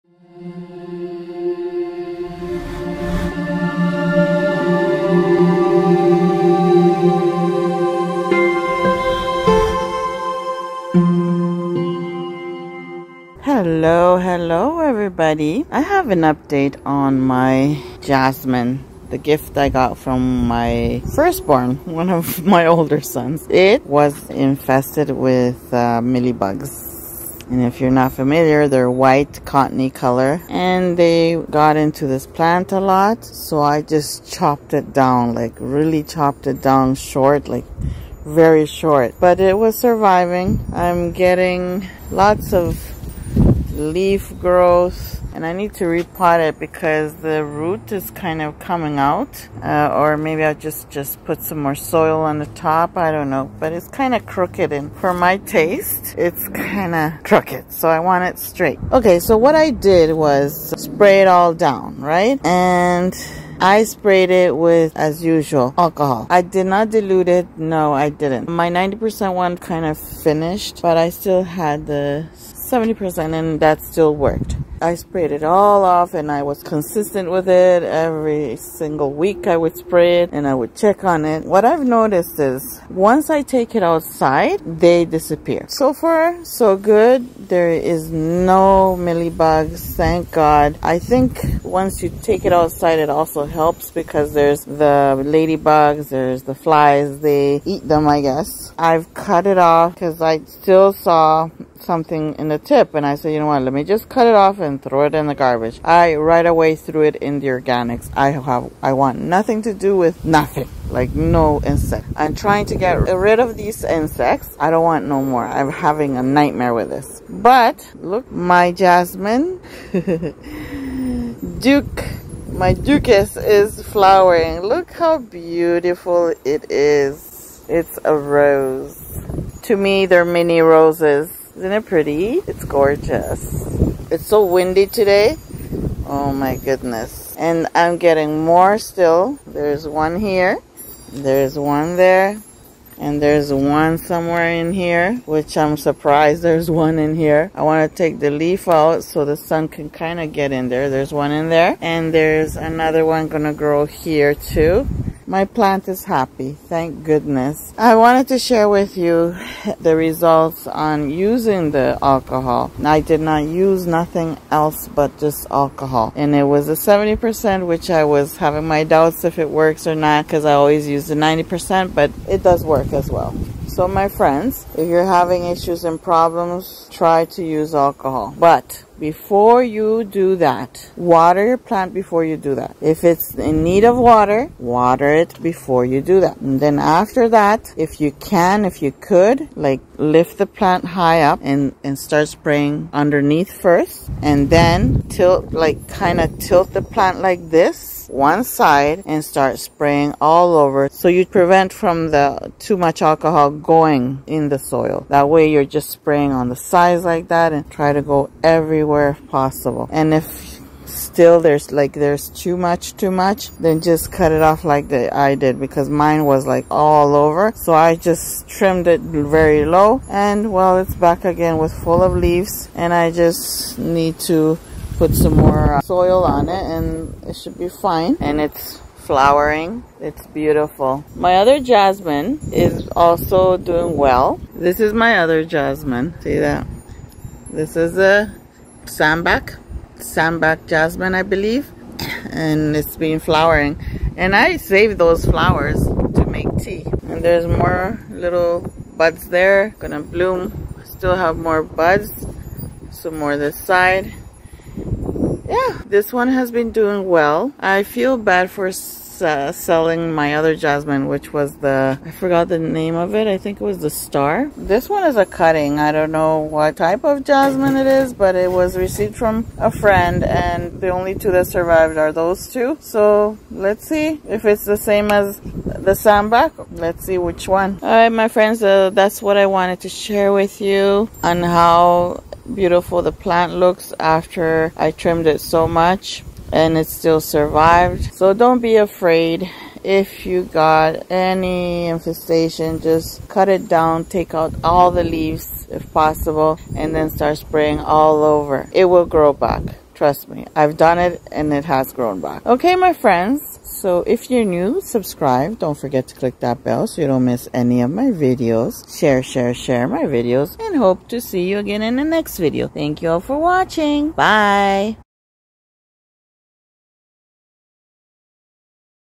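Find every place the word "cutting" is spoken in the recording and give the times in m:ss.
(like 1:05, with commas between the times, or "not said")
4:25.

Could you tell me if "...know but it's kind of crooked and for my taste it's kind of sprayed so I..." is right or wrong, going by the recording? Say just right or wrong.
wrong.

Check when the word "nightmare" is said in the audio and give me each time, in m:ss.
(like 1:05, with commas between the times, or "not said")
1:56.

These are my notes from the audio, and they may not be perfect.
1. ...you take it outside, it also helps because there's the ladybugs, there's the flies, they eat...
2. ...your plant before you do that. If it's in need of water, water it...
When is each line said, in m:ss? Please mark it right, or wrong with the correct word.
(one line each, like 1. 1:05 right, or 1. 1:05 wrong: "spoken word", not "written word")
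1. 1:32 right
2. 3:01 right.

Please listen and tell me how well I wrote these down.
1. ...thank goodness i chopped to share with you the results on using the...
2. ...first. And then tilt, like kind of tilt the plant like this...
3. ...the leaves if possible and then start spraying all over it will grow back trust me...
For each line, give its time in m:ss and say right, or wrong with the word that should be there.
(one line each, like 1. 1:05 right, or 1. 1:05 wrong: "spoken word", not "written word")
1. 2:36 wrong: "wanted", not "chopped"
2. 3:13 right
3. 4:54 right.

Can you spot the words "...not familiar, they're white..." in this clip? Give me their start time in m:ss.
0:27.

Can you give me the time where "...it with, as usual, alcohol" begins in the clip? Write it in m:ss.
1:04.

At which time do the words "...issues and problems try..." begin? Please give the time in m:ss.
2:55.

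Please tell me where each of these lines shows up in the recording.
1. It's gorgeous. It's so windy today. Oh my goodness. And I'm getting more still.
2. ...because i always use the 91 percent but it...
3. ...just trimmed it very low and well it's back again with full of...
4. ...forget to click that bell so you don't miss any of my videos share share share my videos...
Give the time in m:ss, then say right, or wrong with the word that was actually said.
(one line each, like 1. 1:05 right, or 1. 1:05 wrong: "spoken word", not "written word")
1. 2:12 right
2. 2:50 wrong: "90", not "91"
3. 3:37 right
4. 5:05 right.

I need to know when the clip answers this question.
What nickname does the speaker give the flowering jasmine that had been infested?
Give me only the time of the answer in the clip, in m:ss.
2:02.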